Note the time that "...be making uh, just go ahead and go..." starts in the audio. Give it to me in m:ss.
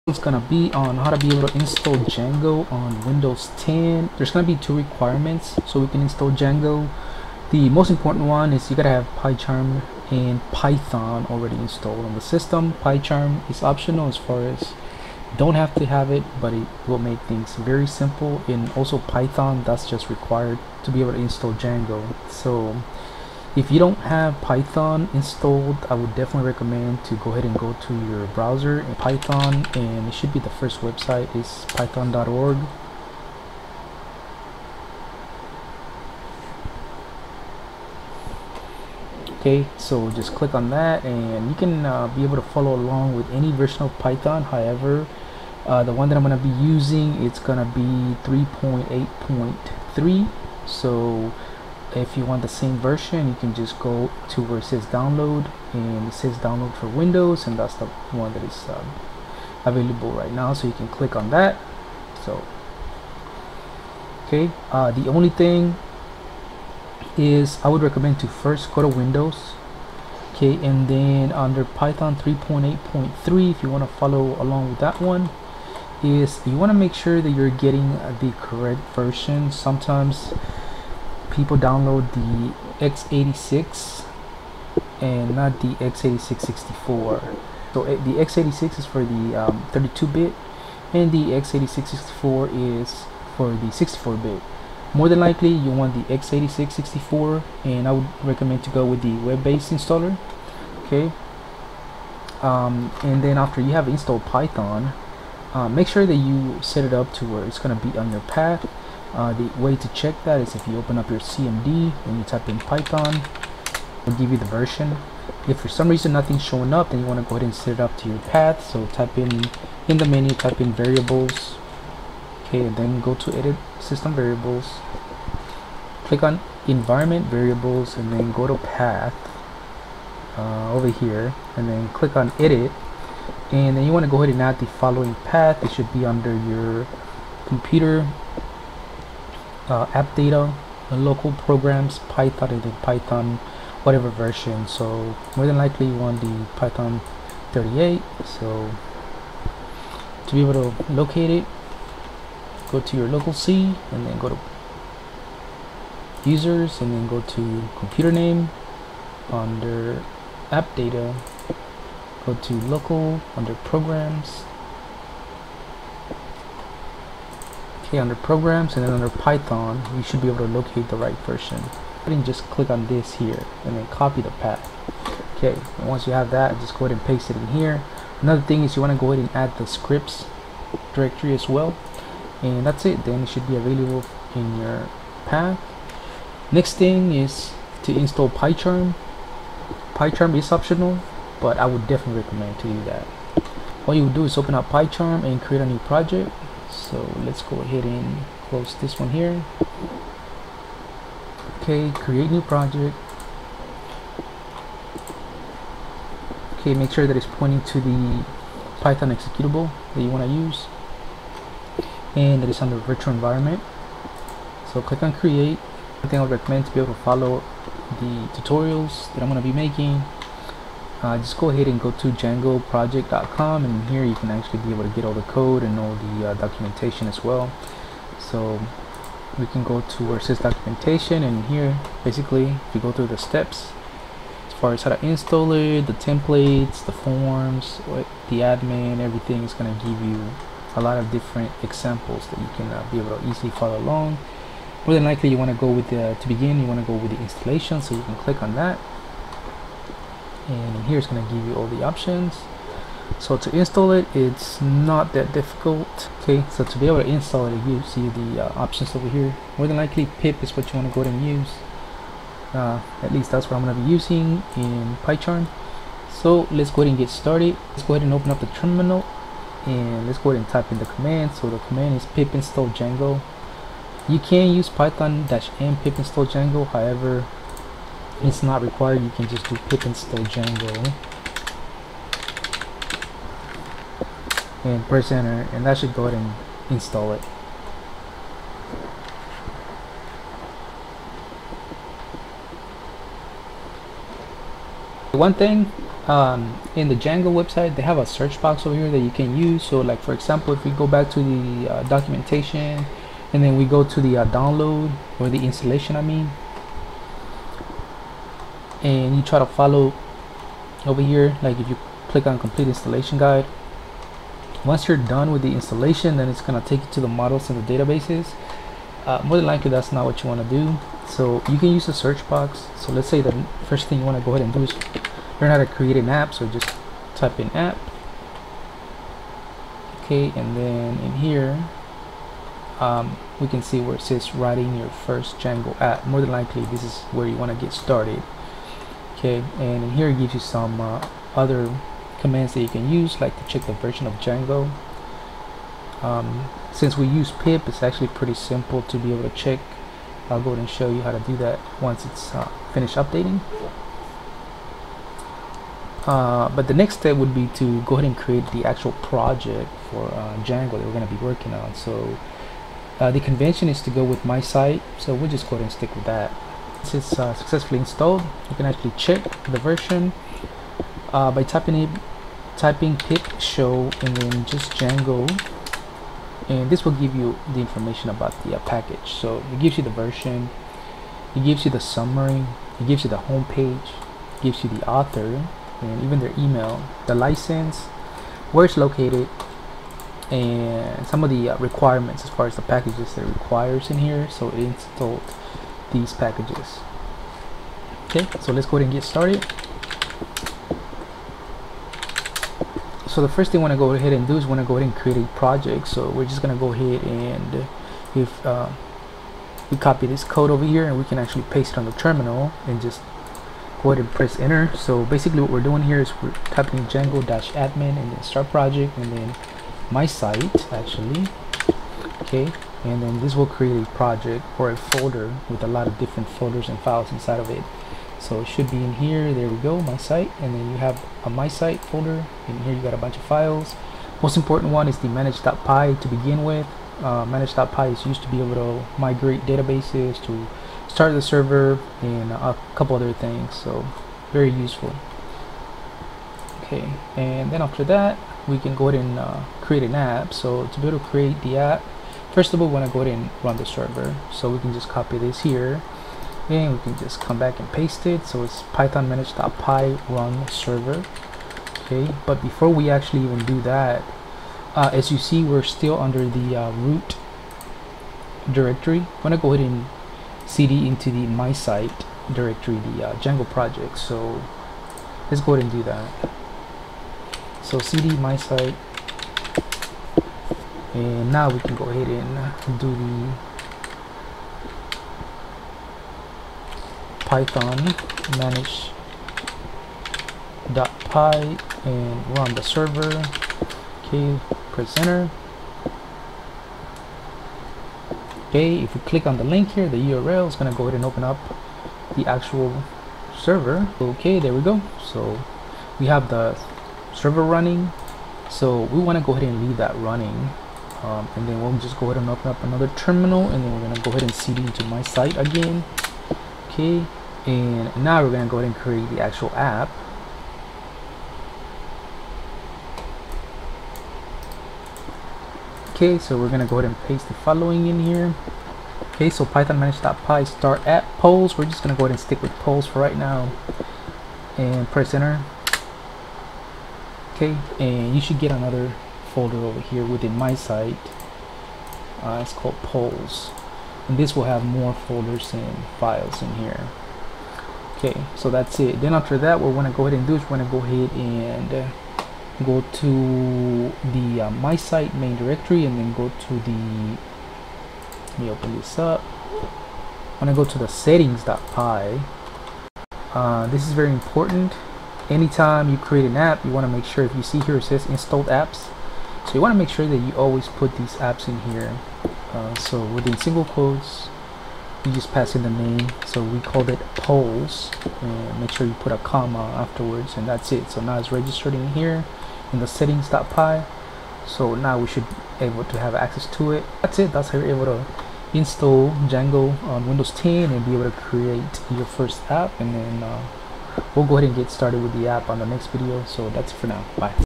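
3:39.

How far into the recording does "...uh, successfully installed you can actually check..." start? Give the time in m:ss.
6:07.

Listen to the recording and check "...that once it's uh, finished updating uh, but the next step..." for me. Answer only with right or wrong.
right.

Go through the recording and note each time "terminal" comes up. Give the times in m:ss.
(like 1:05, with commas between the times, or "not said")
4:28, 6:51, 8:32.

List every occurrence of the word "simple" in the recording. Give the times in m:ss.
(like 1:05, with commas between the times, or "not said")
0:17, 5:48.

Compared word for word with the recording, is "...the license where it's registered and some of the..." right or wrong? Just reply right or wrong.
wrong.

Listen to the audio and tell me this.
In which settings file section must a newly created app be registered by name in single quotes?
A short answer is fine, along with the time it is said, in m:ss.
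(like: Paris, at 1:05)
installed apps, at 9:28.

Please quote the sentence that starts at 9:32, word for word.
Uh, so within single quotes, you just pass in the name.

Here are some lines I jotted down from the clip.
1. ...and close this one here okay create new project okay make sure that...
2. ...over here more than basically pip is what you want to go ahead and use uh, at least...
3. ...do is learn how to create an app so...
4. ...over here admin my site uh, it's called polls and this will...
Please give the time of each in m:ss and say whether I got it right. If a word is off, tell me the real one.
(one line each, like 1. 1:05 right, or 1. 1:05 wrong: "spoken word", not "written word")
1. 3:17 right
2. 4:18 wrong: "likely", not "basically"
3. 5:24 right
4. 8:59 wrong: "within", not "admin".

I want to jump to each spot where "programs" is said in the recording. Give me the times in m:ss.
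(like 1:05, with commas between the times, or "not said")
2:21, 2:43, 2:48.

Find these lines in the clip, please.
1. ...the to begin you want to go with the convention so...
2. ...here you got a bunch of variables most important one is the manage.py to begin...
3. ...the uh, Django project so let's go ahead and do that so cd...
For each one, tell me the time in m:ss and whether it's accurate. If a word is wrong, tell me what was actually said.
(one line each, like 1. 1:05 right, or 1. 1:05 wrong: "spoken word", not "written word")
1. 4:05 wrong: "installation", not "convention"
2. 7:12 wrong: "files", not "variables"
3. 7:52 right.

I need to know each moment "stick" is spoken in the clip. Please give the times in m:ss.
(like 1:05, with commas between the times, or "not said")
6:05, 8:52.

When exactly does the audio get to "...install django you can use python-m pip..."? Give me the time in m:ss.
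4:32.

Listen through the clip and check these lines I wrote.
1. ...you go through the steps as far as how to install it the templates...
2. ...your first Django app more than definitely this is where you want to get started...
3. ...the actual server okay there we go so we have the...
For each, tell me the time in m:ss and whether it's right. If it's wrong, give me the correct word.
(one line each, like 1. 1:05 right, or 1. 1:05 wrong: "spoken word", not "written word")
1. 3:52 right
2. 5:34 wrong: "likely", not "definitely"
3. 8:22 right.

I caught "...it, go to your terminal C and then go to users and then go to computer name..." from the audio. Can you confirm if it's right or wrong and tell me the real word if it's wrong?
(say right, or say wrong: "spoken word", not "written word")
wrong: "local", not "terminal".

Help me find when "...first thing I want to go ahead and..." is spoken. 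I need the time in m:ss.
6:43.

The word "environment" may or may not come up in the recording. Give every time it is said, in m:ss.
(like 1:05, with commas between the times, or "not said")
2:06, 3:33.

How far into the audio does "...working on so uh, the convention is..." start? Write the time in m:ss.
6:01.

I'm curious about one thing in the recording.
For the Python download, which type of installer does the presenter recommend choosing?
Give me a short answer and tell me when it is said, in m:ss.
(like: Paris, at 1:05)
web-based installer, at 1:39.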